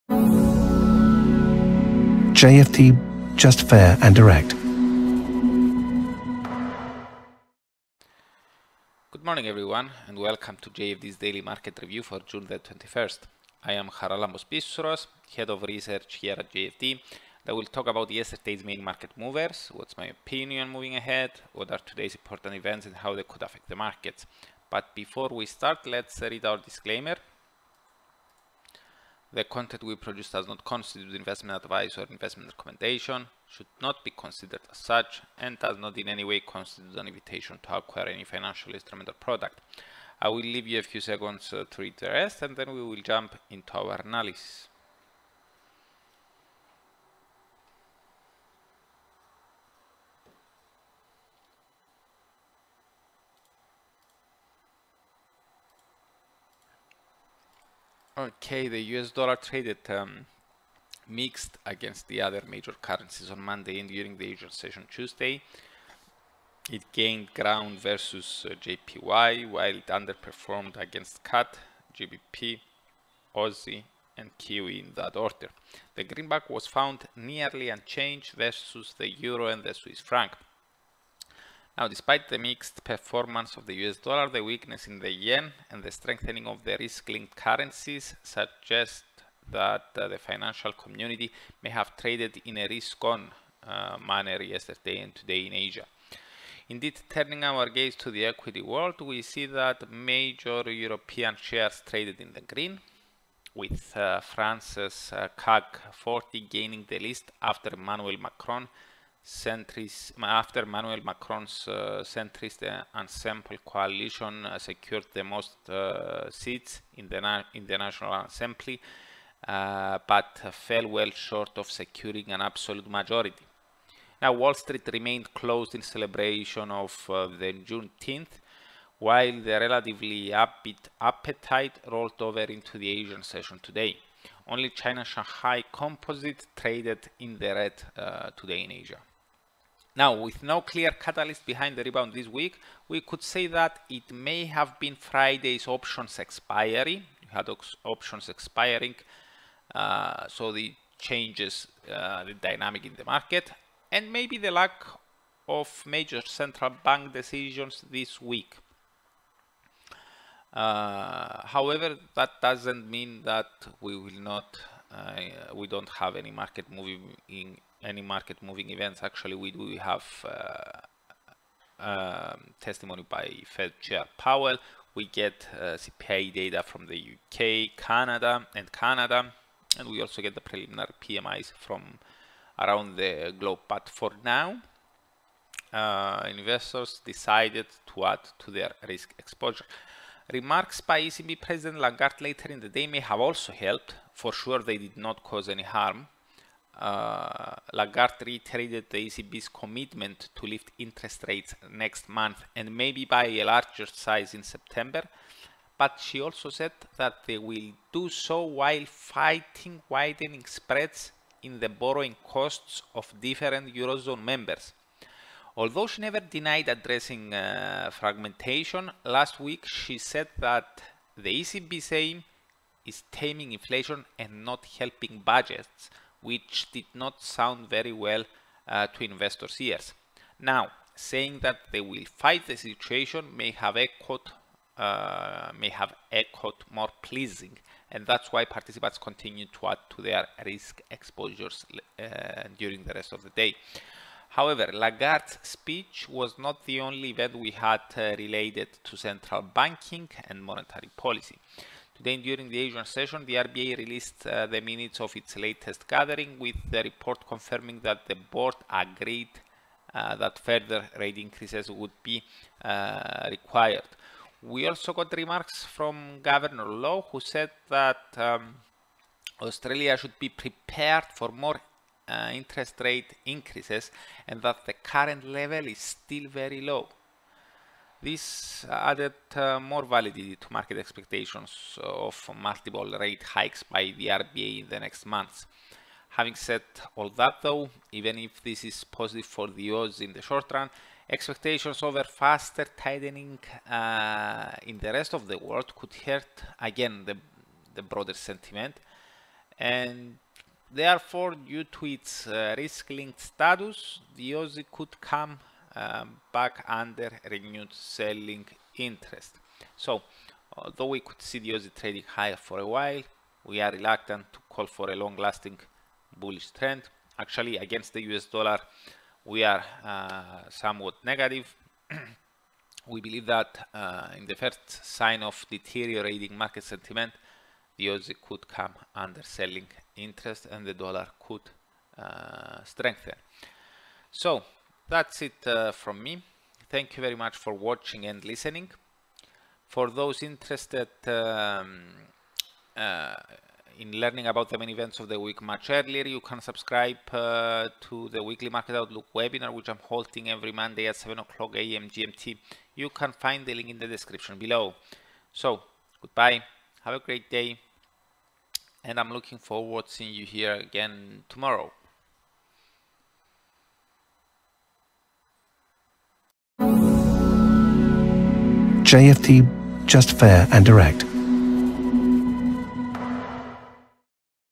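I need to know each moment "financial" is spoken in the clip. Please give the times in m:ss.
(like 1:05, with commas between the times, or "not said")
0:38, 1:30.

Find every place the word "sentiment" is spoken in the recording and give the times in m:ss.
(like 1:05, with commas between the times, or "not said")
4:58, 5:26.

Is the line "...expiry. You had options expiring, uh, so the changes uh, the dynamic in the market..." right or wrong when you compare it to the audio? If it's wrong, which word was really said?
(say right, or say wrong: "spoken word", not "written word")
right.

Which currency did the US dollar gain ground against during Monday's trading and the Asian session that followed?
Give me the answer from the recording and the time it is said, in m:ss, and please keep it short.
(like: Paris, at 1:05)
JPY, at 1:08.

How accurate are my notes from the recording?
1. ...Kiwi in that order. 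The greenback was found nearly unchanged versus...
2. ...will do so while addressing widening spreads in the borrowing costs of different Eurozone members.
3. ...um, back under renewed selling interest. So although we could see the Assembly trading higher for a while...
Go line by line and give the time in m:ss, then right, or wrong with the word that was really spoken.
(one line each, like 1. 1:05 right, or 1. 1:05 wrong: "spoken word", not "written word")
1. 1:14 right
2. 3:27 wrong: "fighting", not "addressing"
3. 5:05 wrong: "Aussie", not "Assembly".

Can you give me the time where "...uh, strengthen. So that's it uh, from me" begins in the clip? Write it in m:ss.
5:31.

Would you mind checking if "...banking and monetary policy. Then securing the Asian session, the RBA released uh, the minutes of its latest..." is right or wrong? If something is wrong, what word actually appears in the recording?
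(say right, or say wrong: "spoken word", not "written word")
wrong: "during", not "securing".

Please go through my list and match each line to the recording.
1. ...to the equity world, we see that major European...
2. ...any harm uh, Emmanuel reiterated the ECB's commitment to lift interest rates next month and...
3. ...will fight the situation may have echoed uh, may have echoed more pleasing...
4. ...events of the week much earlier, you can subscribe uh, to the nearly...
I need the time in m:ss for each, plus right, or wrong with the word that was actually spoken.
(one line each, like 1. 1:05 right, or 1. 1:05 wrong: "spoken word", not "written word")
1. 1:37 right
2. 3:15 wrong: "Lagarde", not "Emmanuel"
3. 3:51 right
4. 5:44 wrong: "weekly", not "nearly".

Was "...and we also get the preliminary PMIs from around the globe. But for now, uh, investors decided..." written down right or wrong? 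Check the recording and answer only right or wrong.
right.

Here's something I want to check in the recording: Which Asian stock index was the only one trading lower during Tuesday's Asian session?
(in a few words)
Shanghai Composite.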